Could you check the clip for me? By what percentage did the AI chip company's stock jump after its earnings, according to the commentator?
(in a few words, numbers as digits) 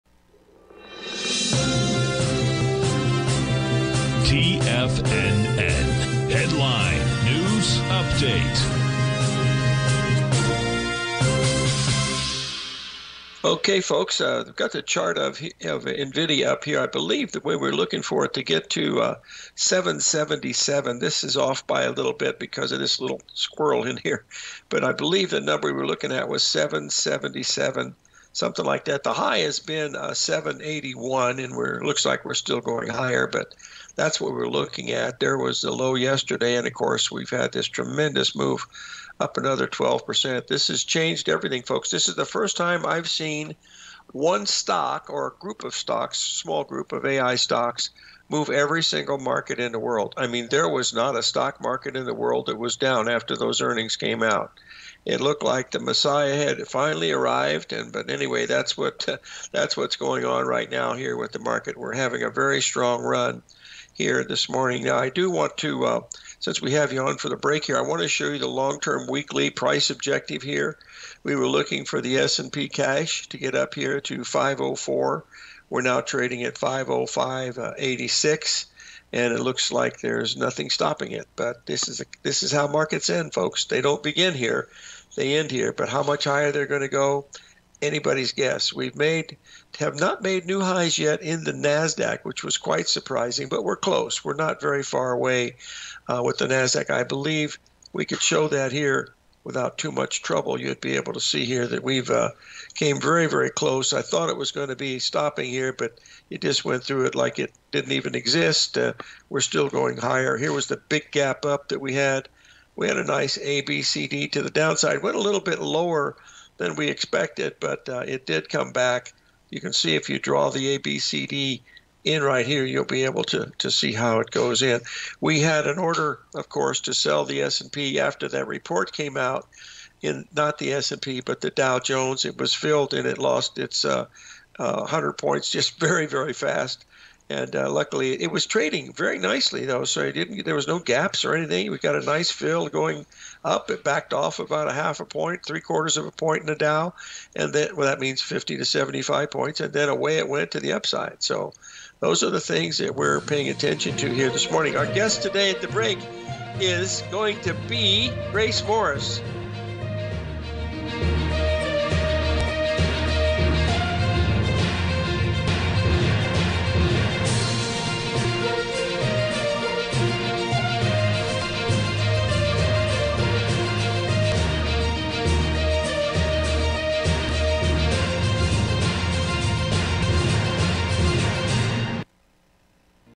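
12%.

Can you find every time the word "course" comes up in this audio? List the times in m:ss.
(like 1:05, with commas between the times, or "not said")
0:36, 2:06.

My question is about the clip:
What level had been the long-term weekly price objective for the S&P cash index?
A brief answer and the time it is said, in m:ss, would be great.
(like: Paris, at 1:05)
504, at 1:14.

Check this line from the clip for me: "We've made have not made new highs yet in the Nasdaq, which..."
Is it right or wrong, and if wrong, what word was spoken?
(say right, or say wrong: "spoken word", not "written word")
right.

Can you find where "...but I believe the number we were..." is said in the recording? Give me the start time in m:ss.
0:24.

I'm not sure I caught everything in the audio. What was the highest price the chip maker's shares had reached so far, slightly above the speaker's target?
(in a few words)
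781.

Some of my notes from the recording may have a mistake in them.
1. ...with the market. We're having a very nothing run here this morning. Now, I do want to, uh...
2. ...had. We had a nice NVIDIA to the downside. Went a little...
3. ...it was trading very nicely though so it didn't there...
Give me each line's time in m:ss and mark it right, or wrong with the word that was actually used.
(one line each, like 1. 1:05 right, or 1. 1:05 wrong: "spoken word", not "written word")
1. 1:01 wrong: "strong", not "nothing"
2. 1:51 wrong: "ABCD", not "NVIDIA"
3. 2:18 right.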